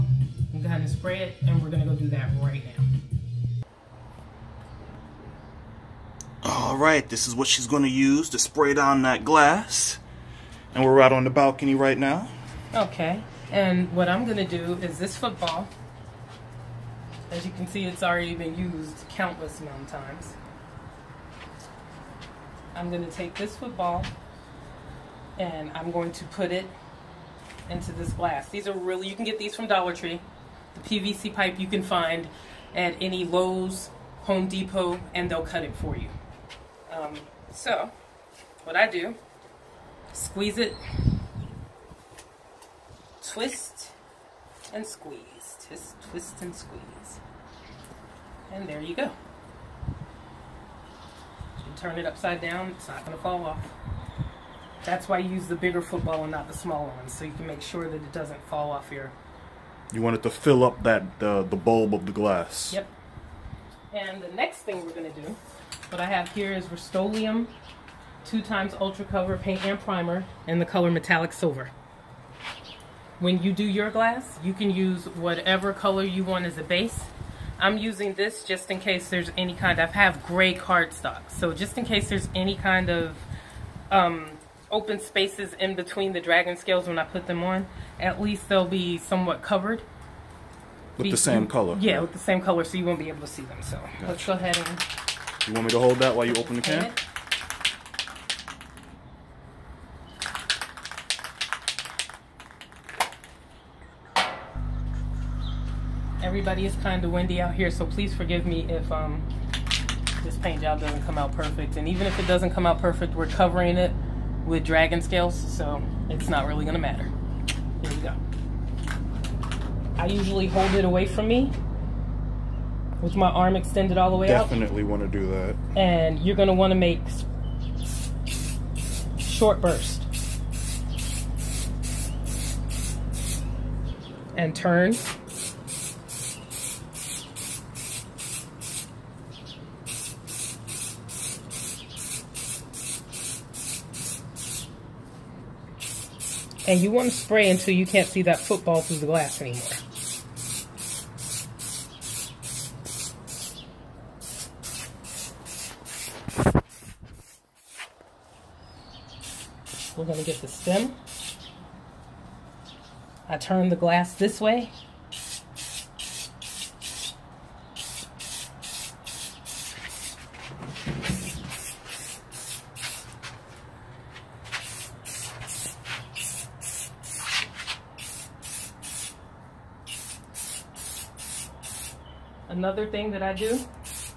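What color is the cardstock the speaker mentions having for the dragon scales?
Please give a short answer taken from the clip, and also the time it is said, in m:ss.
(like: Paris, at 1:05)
Gray, at 1:20.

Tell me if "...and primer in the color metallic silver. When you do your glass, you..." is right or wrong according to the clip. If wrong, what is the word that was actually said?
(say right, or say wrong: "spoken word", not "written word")
right.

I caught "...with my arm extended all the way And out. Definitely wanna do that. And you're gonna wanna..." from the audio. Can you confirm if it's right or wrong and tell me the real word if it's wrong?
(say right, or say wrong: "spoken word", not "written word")
wrong: "Definitely", not "And".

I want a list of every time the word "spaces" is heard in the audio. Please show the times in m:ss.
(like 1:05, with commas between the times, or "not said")
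1:24.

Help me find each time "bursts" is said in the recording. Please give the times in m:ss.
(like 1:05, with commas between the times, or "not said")
2:09.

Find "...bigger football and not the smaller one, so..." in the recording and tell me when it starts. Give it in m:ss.
0:55.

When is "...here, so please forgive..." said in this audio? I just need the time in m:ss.
1:47.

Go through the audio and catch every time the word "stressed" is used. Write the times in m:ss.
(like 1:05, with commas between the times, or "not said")
not said.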